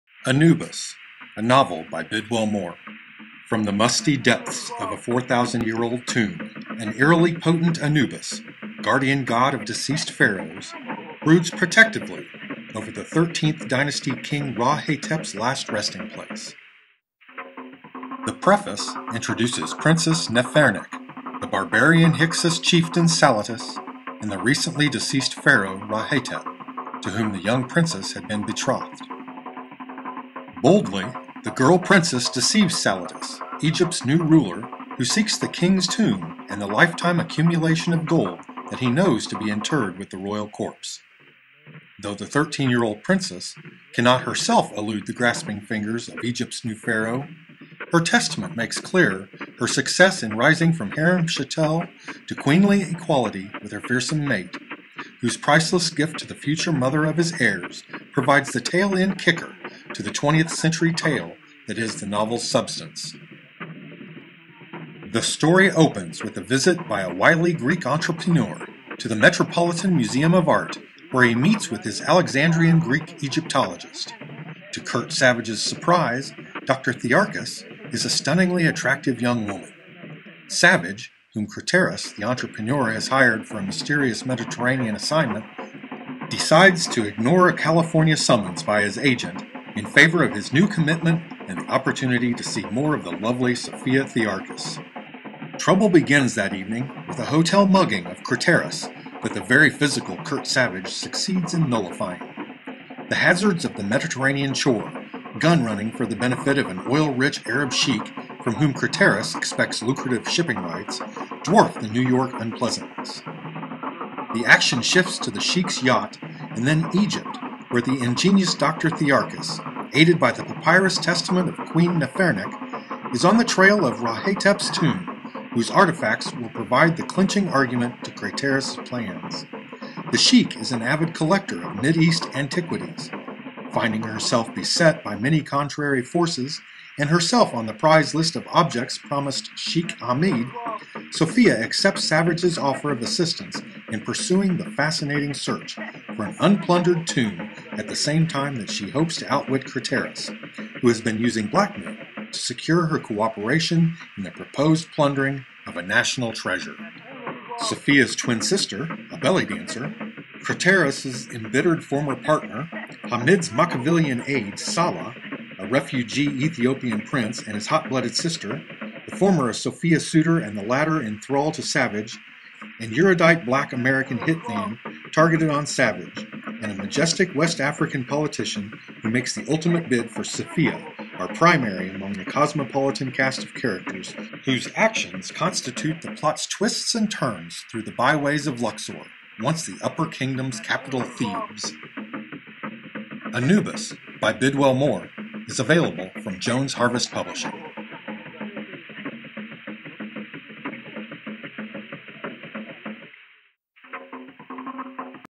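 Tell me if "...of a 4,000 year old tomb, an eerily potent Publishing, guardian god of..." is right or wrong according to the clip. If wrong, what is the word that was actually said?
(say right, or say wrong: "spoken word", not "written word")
wrong: "Anubis", not "Publishing".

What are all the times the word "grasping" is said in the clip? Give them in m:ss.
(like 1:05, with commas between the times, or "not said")
0:45.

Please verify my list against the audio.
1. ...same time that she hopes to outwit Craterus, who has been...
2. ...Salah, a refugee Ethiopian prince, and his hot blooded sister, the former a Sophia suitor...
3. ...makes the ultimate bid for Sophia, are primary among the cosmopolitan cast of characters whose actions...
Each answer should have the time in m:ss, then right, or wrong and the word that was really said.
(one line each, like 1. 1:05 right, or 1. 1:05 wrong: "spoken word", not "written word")
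1. 2:27 right
2. 2:44 right
3. 2:59 right.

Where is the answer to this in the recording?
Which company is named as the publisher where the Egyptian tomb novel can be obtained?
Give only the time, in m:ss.
3:16.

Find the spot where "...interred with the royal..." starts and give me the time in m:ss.
0:39.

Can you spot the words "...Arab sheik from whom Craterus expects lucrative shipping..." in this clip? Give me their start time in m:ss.
1:47.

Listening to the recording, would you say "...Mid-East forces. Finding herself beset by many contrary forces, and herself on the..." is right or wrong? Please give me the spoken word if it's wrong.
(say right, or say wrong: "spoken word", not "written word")
wrong: "antiquities", not "forces".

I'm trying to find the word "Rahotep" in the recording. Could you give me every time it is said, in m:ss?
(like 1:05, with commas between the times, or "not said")
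2:03.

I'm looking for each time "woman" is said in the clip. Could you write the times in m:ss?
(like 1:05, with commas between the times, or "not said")
1:19.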